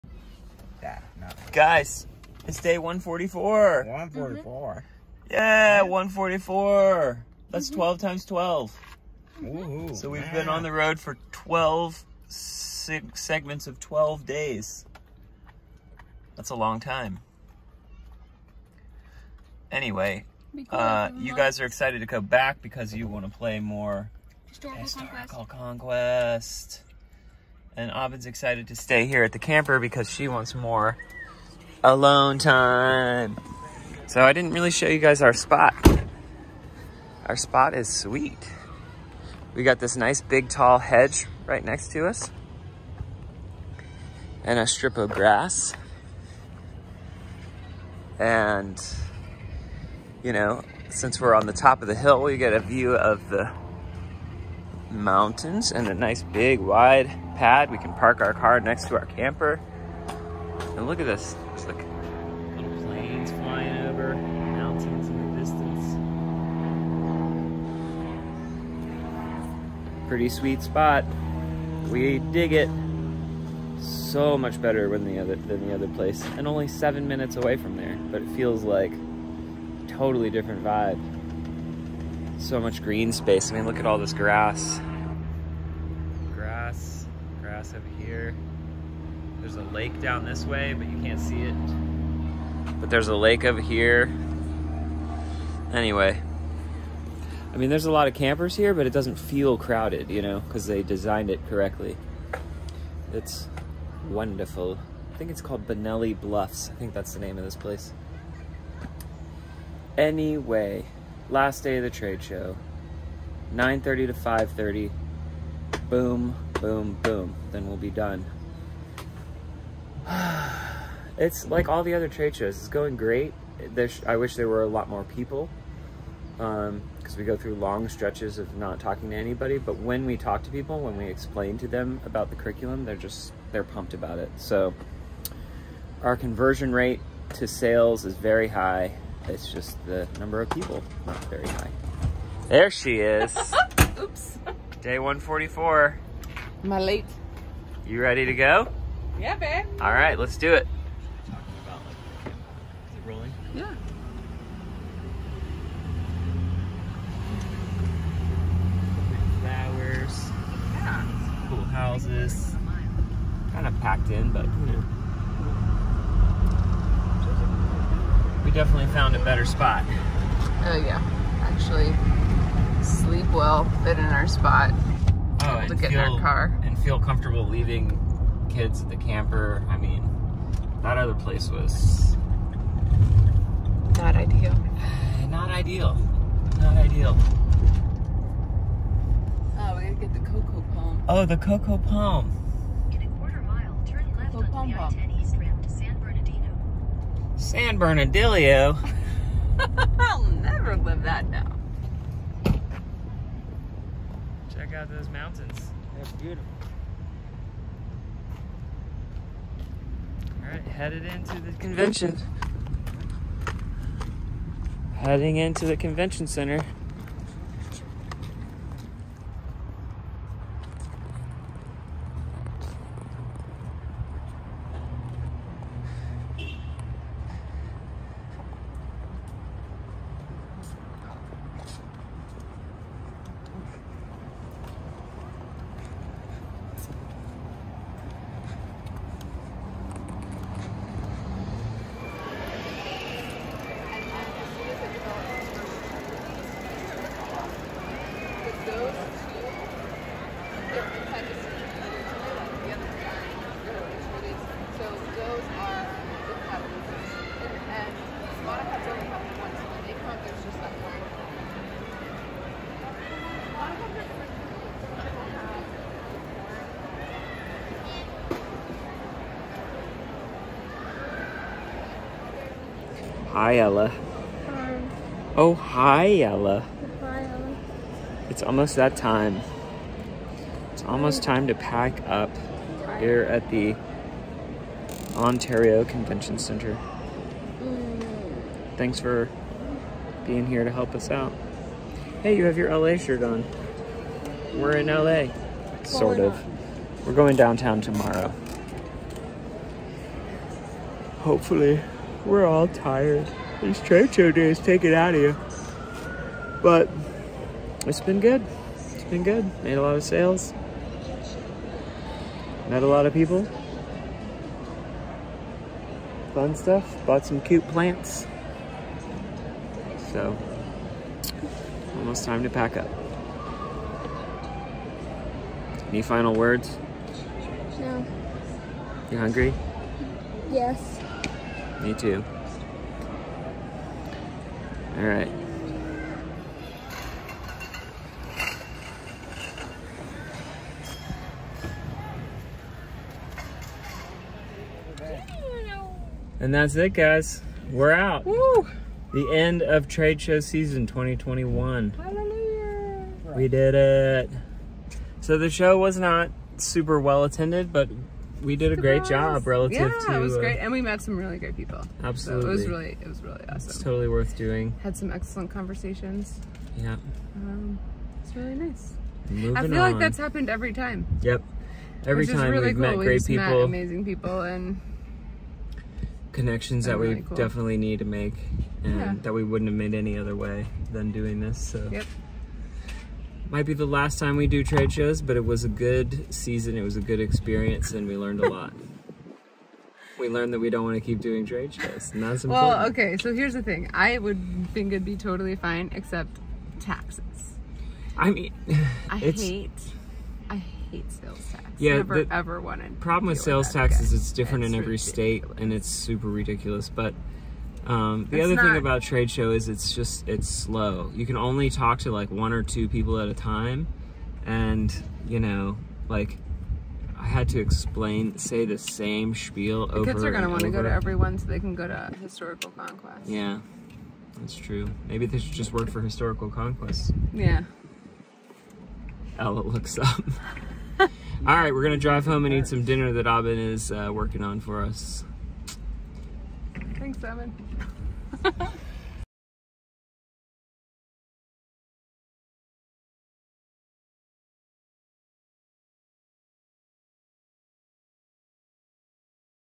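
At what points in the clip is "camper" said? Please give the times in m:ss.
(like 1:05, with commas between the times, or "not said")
0:29, 0:59, 1:38, 2:58.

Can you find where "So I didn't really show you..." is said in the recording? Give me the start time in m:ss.
0:34.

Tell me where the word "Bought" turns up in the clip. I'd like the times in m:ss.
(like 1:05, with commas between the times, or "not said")
5:17.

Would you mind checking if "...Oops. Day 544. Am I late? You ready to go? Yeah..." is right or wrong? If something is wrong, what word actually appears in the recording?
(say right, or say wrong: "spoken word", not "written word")
wrong: "144", not "544".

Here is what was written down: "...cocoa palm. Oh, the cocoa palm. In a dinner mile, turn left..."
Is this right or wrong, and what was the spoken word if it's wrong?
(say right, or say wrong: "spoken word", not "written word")
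wrong: "quarter", not "dinner".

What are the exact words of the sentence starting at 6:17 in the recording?
definitely need to make, and yeah.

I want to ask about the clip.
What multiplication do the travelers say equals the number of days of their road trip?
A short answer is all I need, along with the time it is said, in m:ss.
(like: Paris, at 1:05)
12 times 12, at 0:07.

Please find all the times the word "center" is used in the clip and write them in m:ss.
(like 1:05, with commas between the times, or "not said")
3:36, 4:46.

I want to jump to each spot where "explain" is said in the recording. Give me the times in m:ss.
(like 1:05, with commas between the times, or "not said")
2:11, 6:57.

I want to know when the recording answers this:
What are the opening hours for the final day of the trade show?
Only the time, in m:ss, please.
1:53.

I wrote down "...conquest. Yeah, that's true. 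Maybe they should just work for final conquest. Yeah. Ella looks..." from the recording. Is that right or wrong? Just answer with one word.
wrong.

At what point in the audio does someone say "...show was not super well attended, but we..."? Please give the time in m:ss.
5:55.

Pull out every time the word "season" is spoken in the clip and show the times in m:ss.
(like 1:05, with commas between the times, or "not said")
5:50, 6:26.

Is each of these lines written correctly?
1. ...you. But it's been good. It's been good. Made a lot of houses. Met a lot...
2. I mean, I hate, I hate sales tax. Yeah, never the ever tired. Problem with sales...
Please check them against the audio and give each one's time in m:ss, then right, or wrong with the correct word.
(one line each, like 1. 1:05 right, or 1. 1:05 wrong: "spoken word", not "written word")
1. 5:05 wrong: "sales", not "houses"
2. 6:38 wrong: "wanted", not "tired".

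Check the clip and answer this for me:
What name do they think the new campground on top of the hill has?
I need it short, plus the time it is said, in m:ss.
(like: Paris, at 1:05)
Benelli Bluffs, at 1:45.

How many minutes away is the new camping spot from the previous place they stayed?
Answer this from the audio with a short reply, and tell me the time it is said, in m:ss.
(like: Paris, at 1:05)
7, at 1:16.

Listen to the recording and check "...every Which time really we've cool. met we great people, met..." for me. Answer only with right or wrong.
right.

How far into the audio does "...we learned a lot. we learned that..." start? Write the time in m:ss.
6:28.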